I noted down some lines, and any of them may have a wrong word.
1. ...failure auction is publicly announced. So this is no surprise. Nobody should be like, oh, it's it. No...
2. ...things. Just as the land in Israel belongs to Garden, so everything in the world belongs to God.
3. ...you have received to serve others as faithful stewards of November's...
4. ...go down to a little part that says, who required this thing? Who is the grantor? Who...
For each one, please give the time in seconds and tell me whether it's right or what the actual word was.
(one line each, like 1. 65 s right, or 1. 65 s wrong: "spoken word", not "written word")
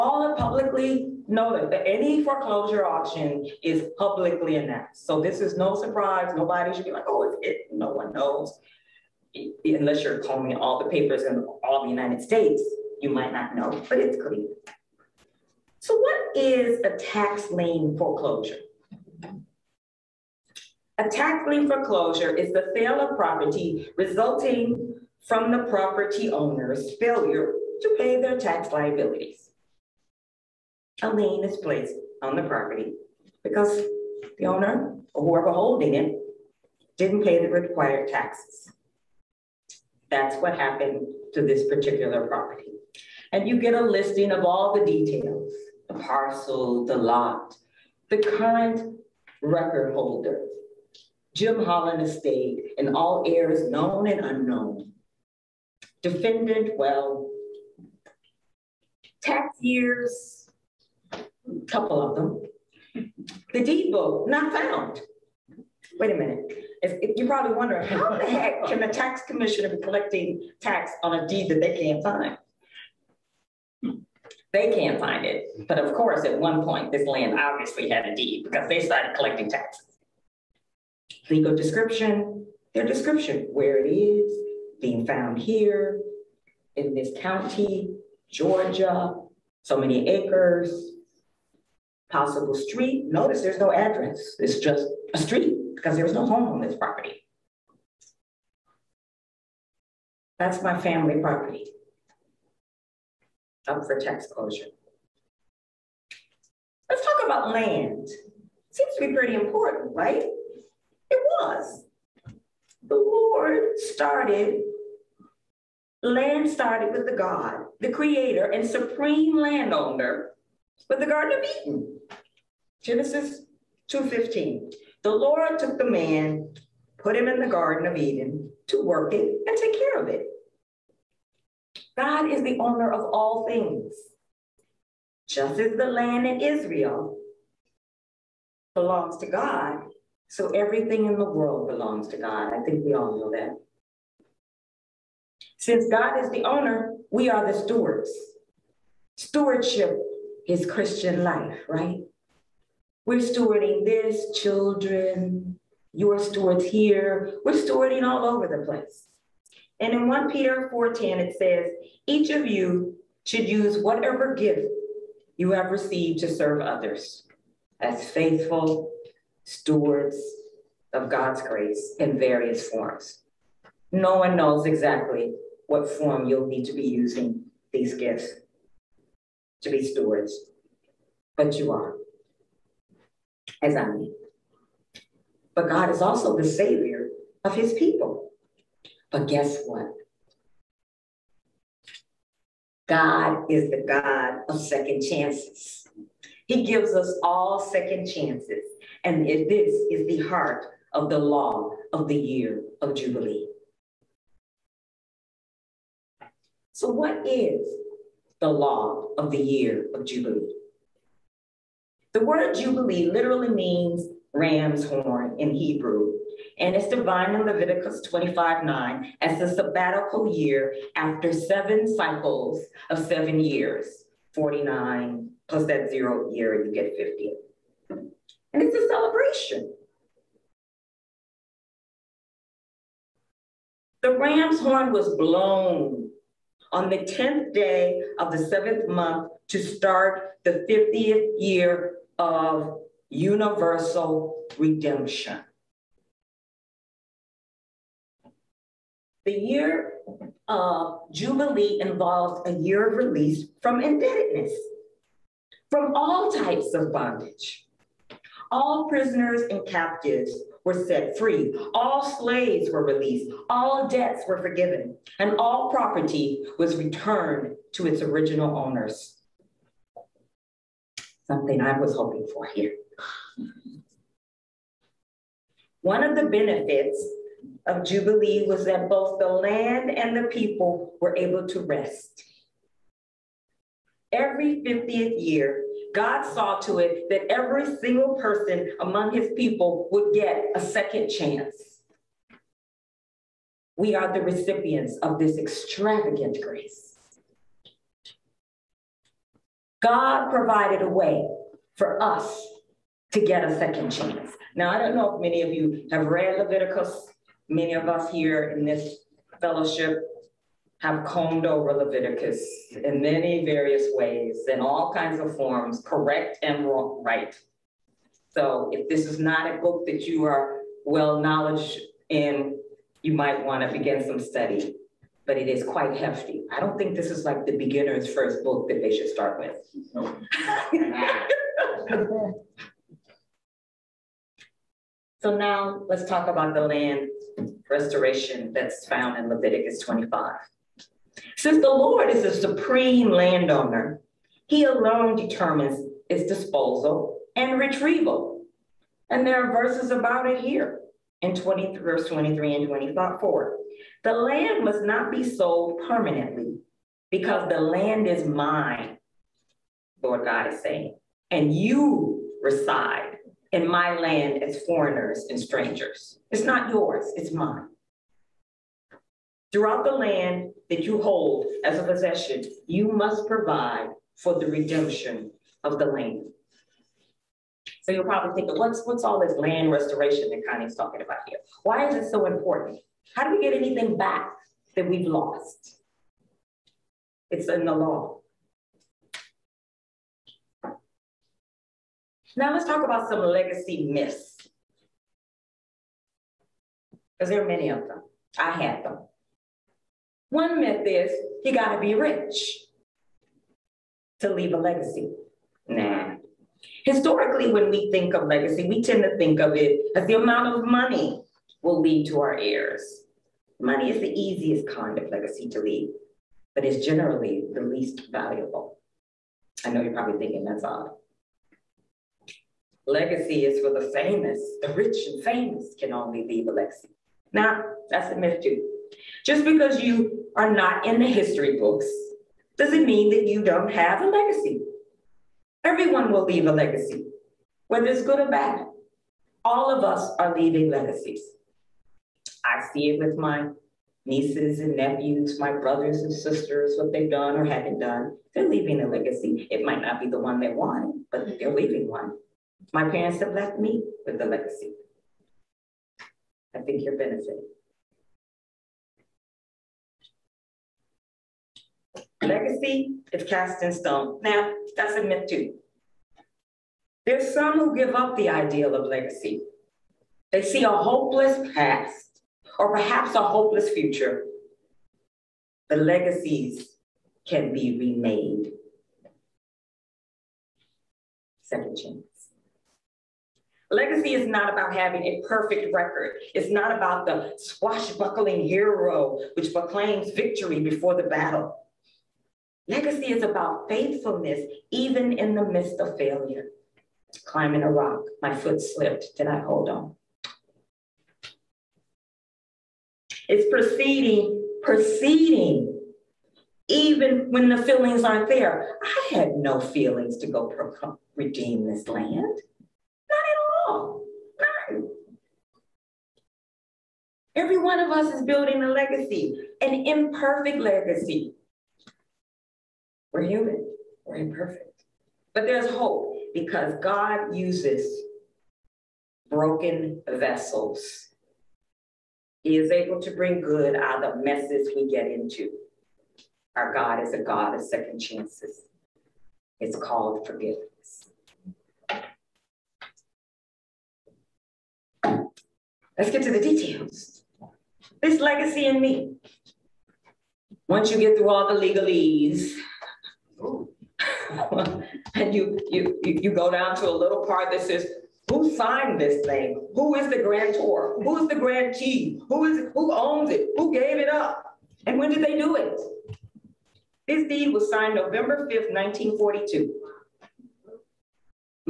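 1. 2 s wrong: "foreclosure", not "failure"
2. 133 s wrong: "God", not "Garden"
3. 165 s wrong: "God", not "November"
4. 556 s wrong: "signed", not "required".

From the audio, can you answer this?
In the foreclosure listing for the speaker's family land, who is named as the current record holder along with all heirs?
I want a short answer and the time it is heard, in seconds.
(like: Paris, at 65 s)
Jim Holland Estate, at 51 s.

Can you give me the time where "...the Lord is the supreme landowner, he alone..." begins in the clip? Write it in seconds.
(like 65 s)
341 s.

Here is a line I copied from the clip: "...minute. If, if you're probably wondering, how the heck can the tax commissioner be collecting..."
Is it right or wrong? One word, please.
right.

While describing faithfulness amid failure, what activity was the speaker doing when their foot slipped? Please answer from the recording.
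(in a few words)
Climbing a rock.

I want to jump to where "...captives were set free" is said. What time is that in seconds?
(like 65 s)
259 s.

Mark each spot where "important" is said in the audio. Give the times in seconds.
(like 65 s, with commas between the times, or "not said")
109 s, 382 s.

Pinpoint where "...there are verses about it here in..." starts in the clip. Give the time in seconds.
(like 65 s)
349 s.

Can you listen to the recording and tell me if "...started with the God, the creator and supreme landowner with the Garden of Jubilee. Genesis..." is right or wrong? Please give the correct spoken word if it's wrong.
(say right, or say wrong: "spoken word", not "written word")
wrong: "Eden", not "Jubilee".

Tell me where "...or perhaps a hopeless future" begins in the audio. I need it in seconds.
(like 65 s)
472 s.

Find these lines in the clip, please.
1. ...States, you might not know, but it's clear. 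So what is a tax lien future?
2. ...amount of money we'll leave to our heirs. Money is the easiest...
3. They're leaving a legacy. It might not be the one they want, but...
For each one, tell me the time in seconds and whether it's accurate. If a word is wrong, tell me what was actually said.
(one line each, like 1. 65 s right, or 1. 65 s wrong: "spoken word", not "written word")
1. 12 s wrong: "foreclosure", not "future"
2. 410 s right
3. 448 s right.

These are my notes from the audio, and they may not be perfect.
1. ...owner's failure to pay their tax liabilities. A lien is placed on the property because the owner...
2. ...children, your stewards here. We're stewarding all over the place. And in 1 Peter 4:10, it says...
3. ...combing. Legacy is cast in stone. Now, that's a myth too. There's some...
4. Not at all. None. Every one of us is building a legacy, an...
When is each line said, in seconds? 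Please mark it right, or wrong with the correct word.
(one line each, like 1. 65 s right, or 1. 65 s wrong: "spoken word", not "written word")
1. 26 s right
2. 154 s right
3. 456 s wrong: "benefiting", not "combing"
4. 513 s right.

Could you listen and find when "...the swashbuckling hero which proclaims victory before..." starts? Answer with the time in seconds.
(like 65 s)
487 s.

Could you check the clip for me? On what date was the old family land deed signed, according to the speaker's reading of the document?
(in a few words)
November 5, 1942.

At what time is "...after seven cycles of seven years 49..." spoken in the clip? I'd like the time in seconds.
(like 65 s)
220 s.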